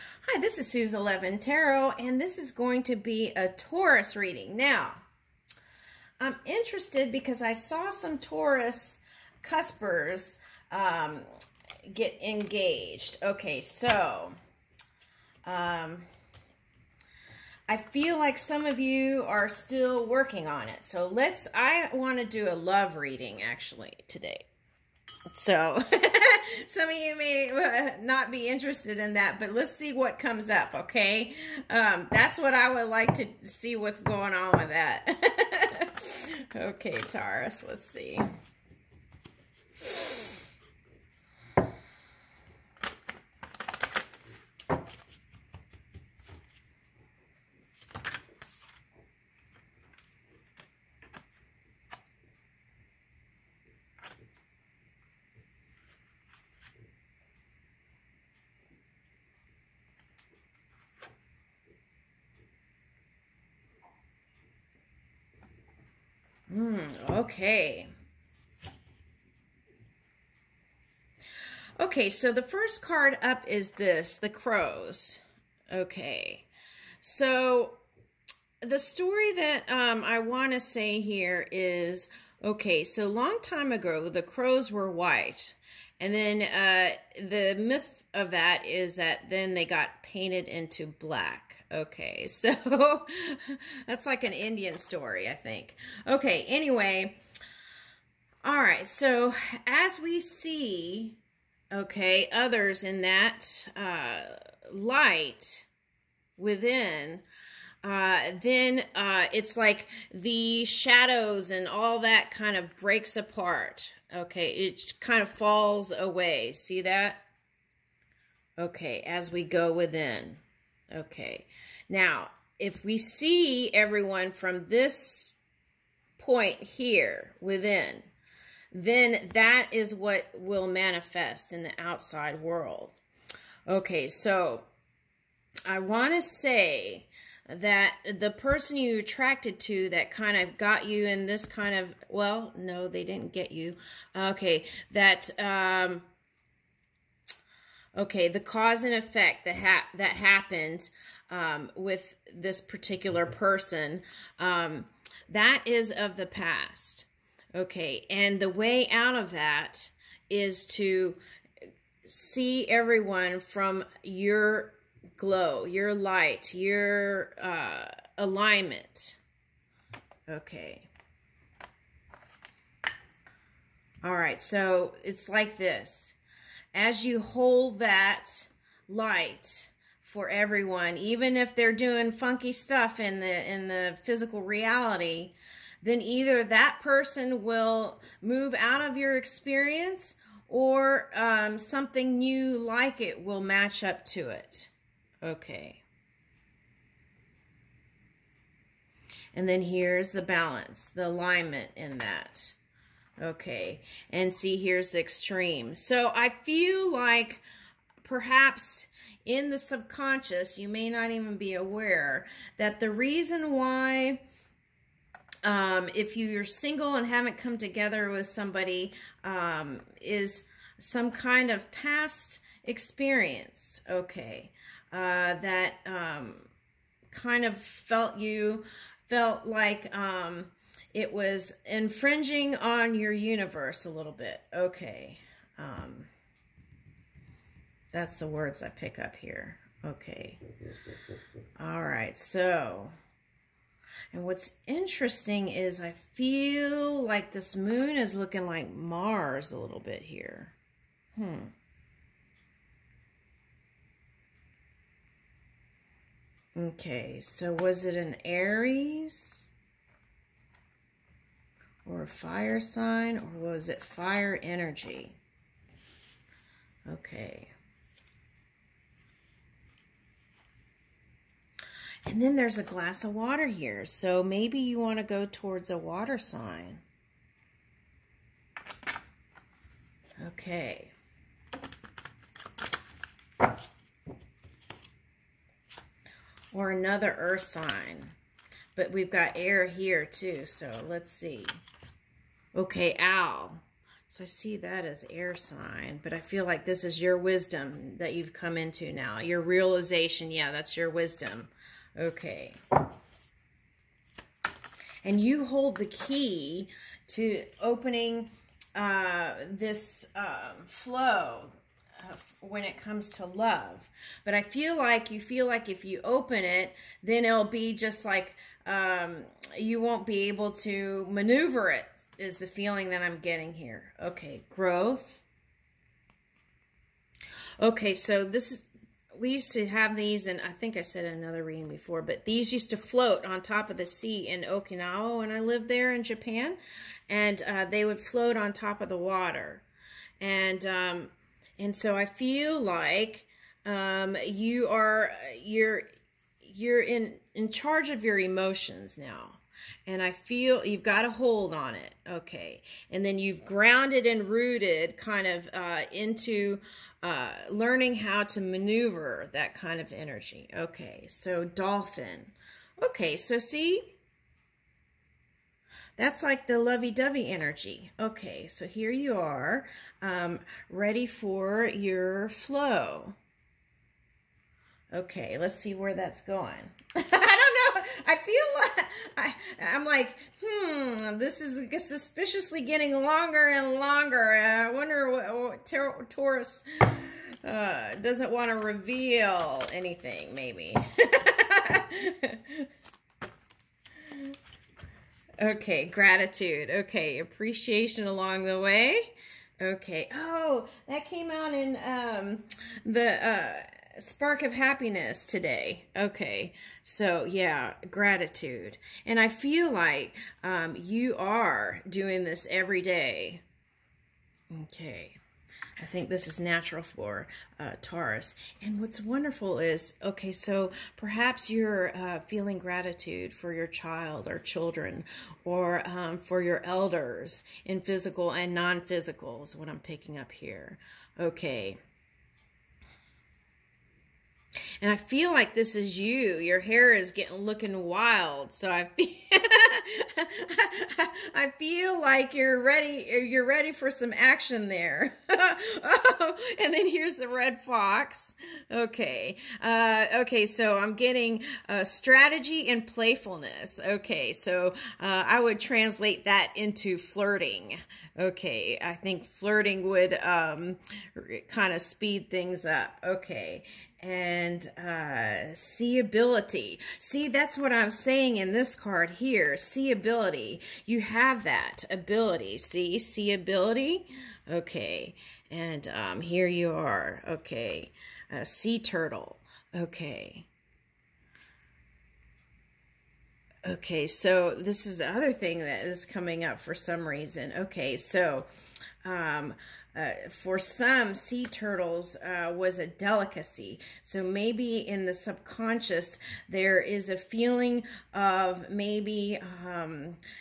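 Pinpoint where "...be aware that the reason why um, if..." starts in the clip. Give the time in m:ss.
3:31.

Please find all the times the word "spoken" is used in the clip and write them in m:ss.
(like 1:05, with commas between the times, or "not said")
not said.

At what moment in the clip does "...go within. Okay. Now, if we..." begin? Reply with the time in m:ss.
1:59.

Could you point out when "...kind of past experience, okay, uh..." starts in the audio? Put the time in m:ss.
3:41.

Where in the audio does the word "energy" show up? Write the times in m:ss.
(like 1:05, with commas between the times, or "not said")
4:24, 5:59, 6:07.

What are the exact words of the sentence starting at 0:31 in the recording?
Um, that's what I would like to see what's going on with that.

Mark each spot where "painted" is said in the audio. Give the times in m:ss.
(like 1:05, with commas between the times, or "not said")
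1:30.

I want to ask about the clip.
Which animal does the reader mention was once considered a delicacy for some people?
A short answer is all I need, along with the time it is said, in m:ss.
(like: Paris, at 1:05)
Sea turtle, at 8:11.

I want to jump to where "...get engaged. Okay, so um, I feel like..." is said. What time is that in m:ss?
0:11.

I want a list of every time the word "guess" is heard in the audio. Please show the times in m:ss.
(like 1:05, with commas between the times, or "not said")
not said.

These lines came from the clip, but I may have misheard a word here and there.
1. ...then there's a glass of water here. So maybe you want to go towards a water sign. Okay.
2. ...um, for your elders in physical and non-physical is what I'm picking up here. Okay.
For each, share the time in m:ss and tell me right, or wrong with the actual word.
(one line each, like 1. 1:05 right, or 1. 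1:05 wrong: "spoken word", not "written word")
1. 4:32 right
2. 7:05 right.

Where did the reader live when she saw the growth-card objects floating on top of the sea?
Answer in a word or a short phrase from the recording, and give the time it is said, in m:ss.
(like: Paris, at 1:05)
Okinawa, at 5:34.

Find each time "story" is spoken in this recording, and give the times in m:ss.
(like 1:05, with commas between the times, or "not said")
1:18, 1:34.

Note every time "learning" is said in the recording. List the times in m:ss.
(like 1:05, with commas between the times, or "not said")
5:57.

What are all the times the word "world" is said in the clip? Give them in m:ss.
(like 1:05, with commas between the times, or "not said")
2:12.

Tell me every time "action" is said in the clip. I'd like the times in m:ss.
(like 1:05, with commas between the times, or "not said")
7:24.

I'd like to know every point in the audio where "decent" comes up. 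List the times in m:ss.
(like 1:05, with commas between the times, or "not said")
not said.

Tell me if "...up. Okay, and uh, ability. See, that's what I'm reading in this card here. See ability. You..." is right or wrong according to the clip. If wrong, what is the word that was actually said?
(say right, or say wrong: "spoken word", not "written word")
wrong: "saying", not "reading".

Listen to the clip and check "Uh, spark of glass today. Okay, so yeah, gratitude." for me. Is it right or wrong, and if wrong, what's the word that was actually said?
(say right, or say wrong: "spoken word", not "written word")
wrong: "happiness", not "glass".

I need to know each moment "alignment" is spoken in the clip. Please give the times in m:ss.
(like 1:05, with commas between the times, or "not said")
2:48, 3:21.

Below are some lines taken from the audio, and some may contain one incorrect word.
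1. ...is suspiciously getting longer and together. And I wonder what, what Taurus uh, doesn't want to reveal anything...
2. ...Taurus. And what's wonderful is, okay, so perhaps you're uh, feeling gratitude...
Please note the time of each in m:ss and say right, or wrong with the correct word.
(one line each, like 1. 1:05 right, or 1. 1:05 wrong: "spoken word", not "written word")
1. 6:21 wrong: "longer", not "together"
2. 6:57 right.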